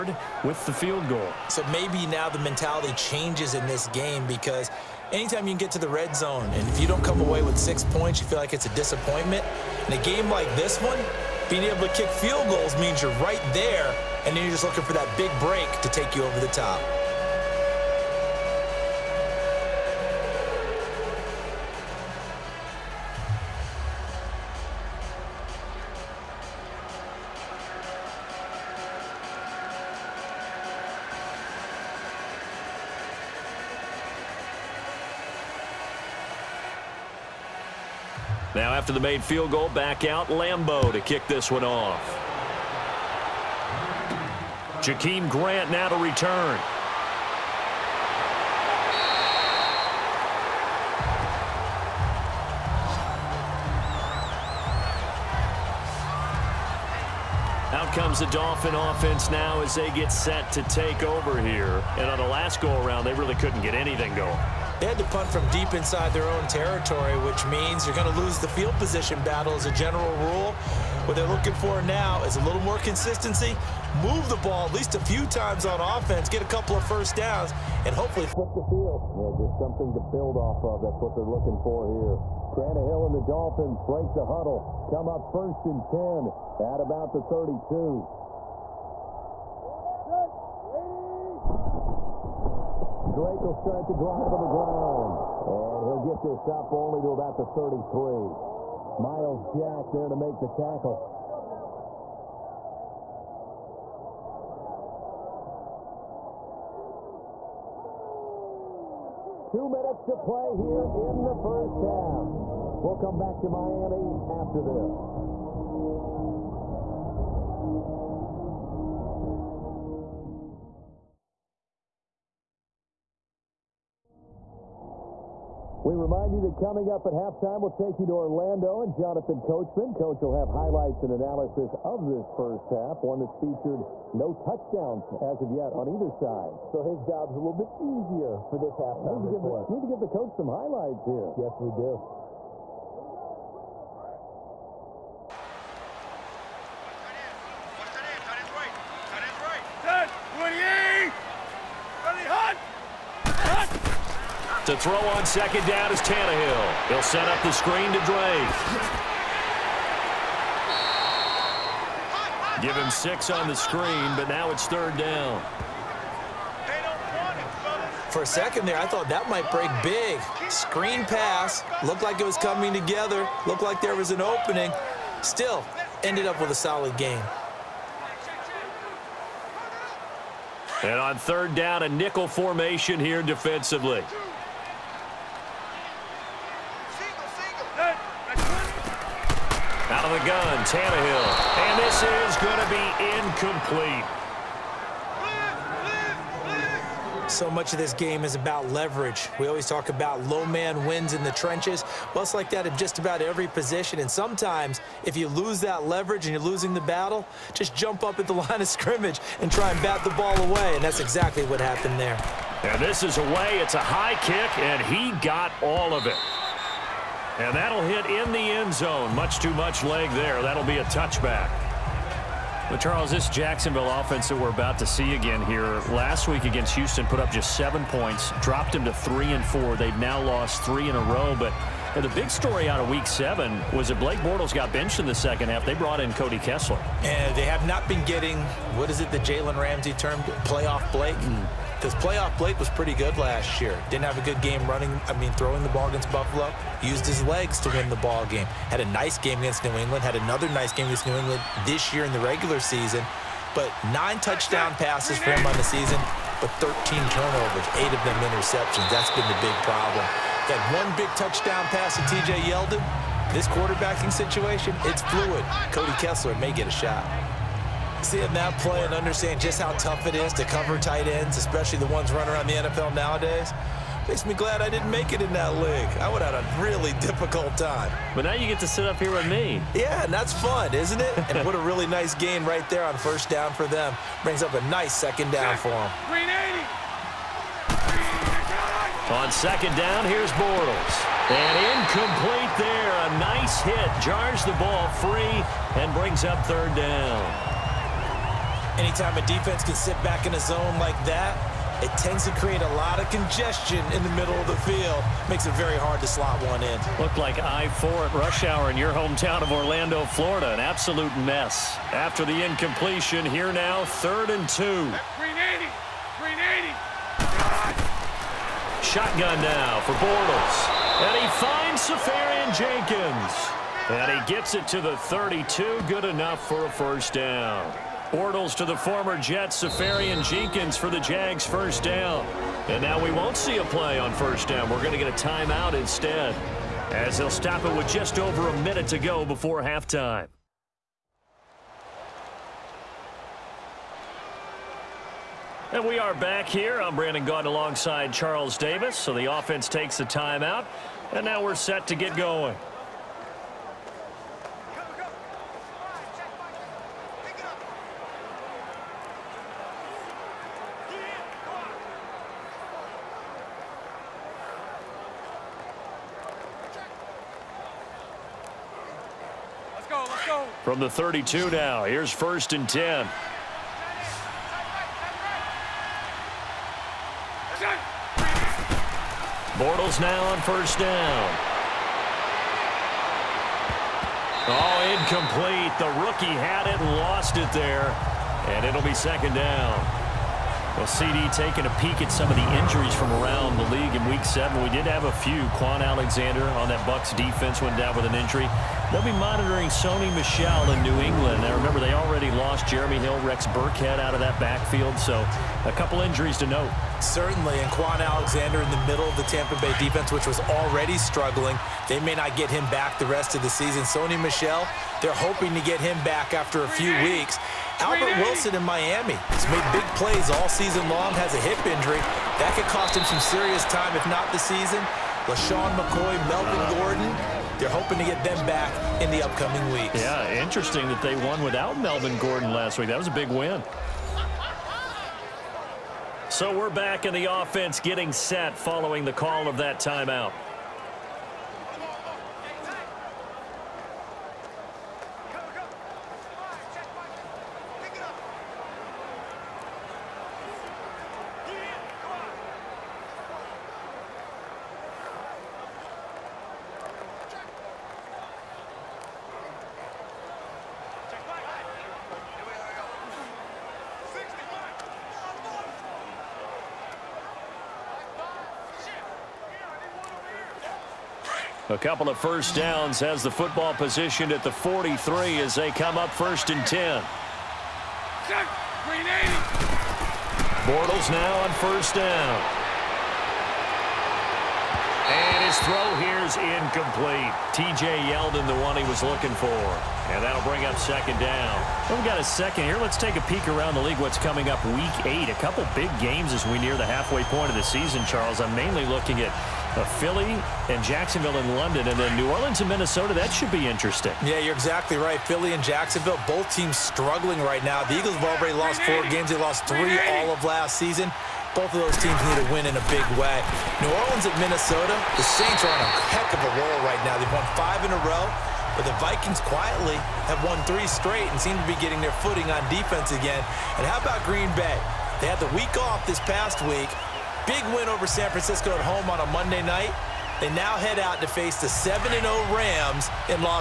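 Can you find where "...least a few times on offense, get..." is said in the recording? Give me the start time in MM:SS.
01:14.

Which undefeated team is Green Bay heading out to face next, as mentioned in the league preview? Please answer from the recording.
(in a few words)
Rams.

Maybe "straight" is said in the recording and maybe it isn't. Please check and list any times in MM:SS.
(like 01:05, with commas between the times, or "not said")
08:40.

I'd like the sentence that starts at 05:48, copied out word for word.
So the offense takes the timeout.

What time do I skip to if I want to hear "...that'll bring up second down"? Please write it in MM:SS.
08:10.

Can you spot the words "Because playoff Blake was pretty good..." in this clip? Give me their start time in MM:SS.
04:01.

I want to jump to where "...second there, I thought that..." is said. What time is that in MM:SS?
02:48.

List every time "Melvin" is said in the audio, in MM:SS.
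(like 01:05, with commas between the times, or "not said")
07:06, 07:11.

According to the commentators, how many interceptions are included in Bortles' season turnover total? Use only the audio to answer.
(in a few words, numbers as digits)
8.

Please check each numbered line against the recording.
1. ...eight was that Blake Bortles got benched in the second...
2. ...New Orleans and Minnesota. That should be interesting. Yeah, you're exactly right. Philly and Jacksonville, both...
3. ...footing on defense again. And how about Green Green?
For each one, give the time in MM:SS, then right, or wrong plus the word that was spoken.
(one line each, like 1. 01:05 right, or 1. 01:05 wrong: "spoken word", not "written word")
1. 03:53 wrong: "seven", not "eight"
2. 08:22 right
3. 08:42 wrong: "Bay", not "Green".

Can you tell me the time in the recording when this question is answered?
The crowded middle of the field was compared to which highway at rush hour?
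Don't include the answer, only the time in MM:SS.
05:07.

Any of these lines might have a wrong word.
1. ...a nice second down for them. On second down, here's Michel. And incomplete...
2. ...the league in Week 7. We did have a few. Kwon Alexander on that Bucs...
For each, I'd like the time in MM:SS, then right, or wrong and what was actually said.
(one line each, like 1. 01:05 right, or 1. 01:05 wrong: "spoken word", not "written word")
1. 04:44 wrong: "Bortles", not "Michel"
2. 06:33 right.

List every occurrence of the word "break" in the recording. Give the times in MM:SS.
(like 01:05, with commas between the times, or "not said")
00:15, 01:23, 02:49.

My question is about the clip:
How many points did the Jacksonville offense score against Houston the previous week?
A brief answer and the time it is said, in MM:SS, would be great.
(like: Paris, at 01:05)
7, at 03:47.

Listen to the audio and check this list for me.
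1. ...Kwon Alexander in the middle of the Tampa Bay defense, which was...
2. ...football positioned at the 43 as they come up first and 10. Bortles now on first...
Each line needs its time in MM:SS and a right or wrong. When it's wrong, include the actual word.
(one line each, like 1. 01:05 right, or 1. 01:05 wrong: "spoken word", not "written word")
1. 06:47 right
2. 07:53 right.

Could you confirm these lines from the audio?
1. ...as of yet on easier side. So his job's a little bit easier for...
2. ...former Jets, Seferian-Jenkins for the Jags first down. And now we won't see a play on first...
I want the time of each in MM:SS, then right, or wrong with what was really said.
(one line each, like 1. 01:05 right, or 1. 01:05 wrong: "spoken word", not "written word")
1. 02:15 wrong: "either", not "easier"
2. 05:28 right.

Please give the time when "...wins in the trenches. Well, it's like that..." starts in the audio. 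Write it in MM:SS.
03:20.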